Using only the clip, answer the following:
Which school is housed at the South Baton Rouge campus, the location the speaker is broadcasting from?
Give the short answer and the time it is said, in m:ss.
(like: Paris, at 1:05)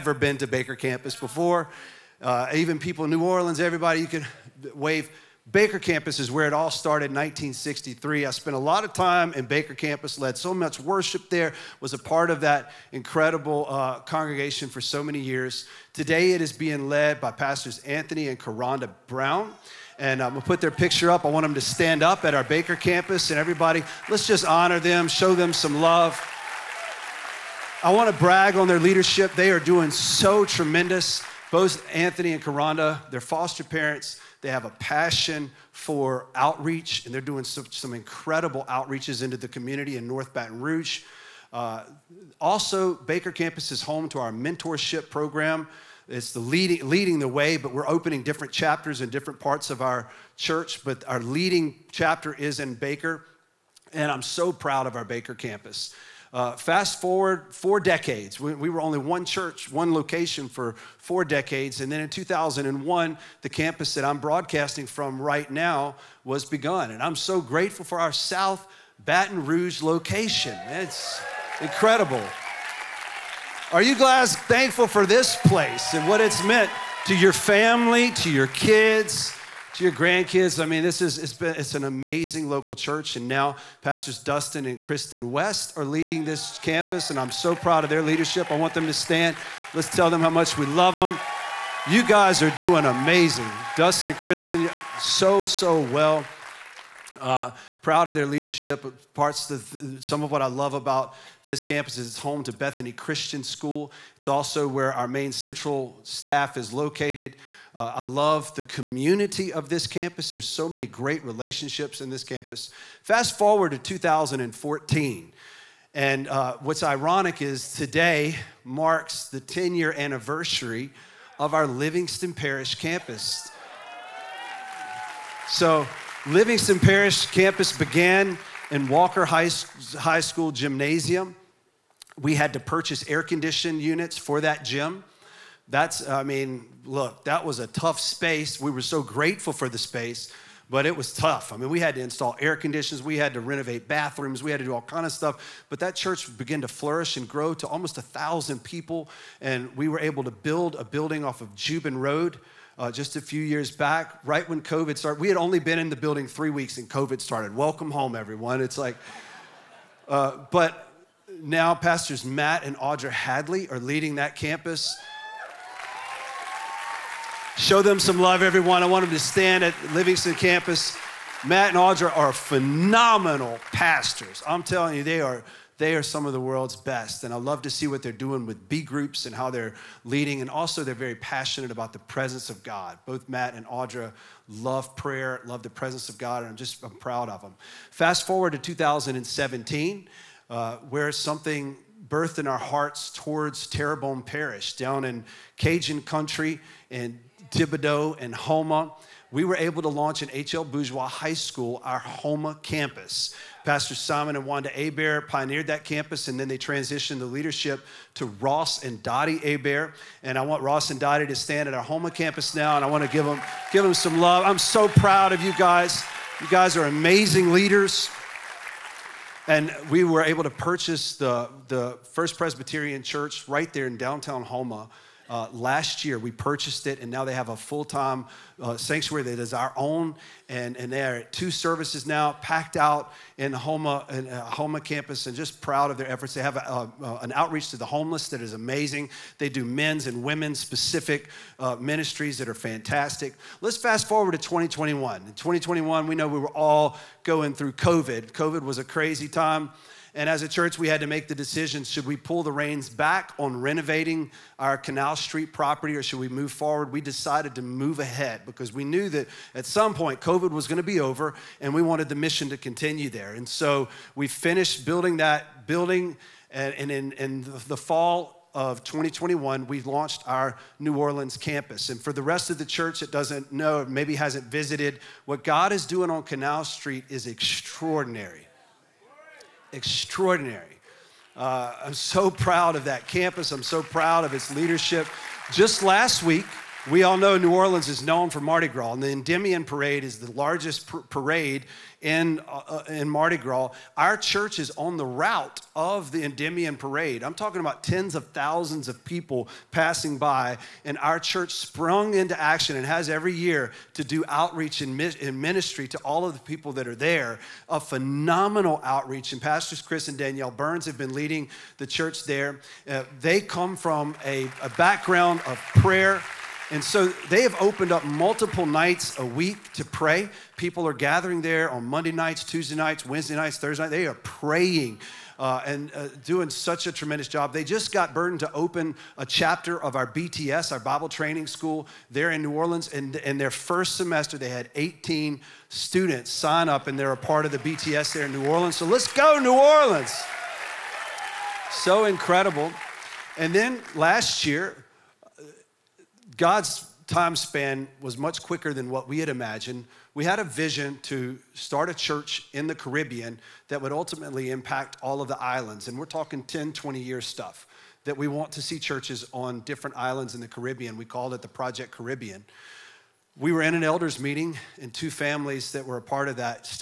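Bethany Christian School, at 1:42.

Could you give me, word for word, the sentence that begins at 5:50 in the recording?
We had a vision to start a church in the Caribbean that would ultimately impact all of the islands.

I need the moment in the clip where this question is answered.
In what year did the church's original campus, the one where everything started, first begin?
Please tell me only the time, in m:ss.
0:07.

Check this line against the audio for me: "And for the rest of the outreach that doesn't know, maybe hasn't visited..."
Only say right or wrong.
wrong.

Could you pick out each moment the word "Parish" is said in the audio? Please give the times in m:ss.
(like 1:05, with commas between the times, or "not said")
2:02, 2:06, 3:14.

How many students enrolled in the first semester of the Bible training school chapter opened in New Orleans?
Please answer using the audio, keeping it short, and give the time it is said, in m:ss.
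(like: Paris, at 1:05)
18, at 5:34.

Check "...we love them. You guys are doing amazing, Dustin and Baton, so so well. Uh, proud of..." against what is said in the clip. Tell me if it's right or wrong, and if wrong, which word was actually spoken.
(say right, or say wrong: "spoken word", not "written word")
wrong: "Kristen", not "Baton".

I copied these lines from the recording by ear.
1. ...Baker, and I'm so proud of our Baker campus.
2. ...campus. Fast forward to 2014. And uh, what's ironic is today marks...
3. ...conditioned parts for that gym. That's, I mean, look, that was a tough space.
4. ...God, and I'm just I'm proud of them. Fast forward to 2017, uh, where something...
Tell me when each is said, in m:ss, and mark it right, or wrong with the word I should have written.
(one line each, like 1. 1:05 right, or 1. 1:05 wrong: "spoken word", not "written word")
1. 0:52 right
2. 1:52 right
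3. 2:13 wrong: "units", not "parts"
4. 3:06 right.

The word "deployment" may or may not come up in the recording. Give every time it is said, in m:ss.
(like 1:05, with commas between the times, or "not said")
not said.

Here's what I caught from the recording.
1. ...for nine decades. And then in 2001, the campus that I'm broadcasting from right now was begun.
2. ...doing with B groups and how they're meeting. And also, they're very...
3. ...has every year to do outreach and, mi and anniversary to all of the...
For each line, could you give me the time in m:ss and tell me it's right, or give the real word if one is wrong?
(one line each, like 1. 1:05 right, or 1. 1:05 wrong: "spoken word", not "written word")
1. 1:00 wrong: "four", not "nine"
2. 2:58 wrong: "leading", not "meeting"
3. 5:02 wrong: "ministry", not "anniversary".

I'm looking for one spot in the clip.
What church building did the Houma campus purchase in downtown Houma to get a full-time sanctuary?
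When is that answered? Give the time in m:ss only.
3:42.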